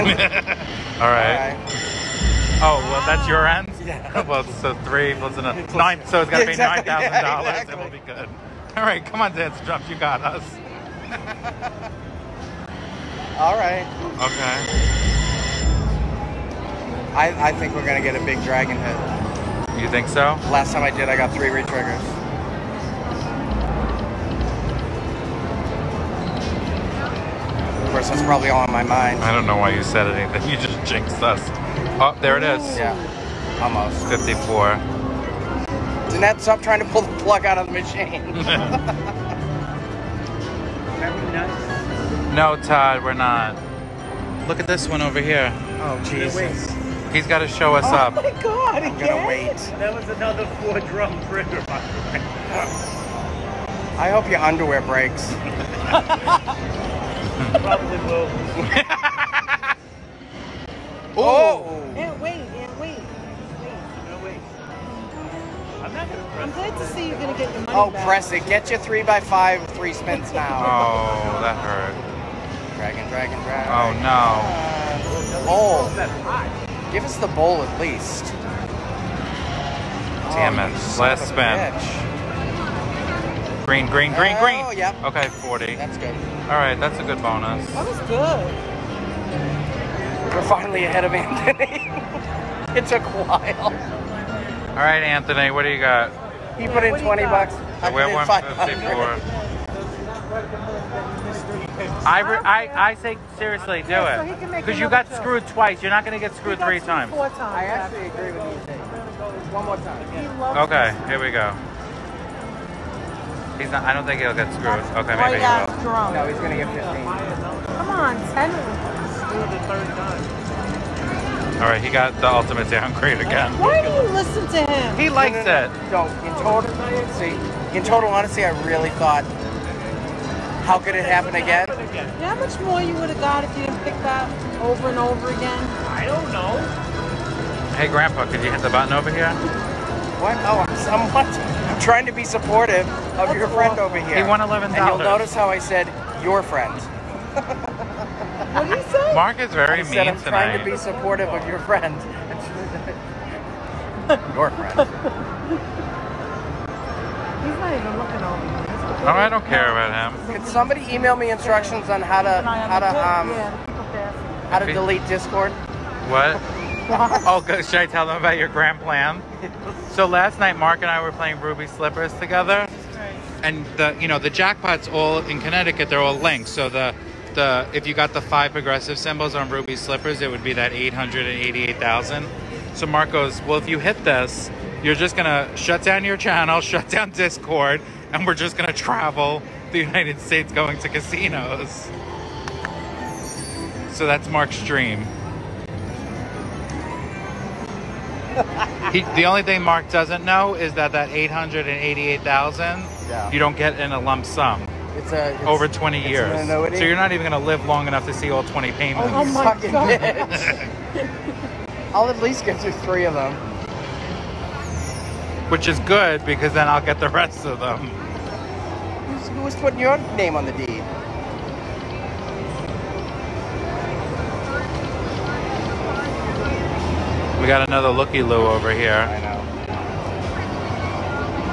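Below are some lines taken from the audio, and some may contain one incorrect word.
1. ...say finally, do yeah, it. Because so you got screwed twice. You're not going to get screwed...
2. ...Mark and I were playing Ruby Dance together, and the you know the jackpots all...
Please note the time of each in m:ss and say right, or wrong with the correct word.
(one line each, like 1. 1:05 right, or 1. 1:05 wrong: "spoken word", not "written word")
1. 1:42 wrong: "seriously", not "finally"
2. 2:50 wrong: "Slippers", not "Dance".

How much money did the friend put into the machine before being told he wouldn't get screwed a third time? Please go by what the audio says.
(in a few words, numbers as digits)
20 bucks.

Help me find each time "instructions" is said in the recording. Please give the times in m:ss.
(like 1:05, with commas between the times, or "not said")
2:41.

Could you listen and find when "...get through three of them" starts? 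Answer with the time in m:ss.
3:32.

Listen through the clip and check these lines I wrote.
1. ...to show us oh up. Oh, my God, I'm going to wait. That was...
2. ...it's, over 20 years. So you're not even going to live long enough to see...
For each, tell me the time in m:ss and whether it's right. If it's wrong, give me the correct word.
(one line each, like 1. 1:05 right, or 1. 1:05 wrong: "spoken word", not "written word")
1. 0:47 right
2. 3:25 right.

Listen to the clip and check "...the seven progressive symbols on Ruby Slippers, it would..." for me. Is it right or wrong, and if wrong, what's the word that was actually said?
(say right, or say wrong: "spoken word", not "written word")
wrong: "five", not "seven".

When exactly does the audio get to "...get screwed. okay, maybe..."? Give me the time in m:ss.
1:54.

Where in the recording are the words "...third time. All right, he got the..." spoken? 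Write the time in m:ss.
1:59.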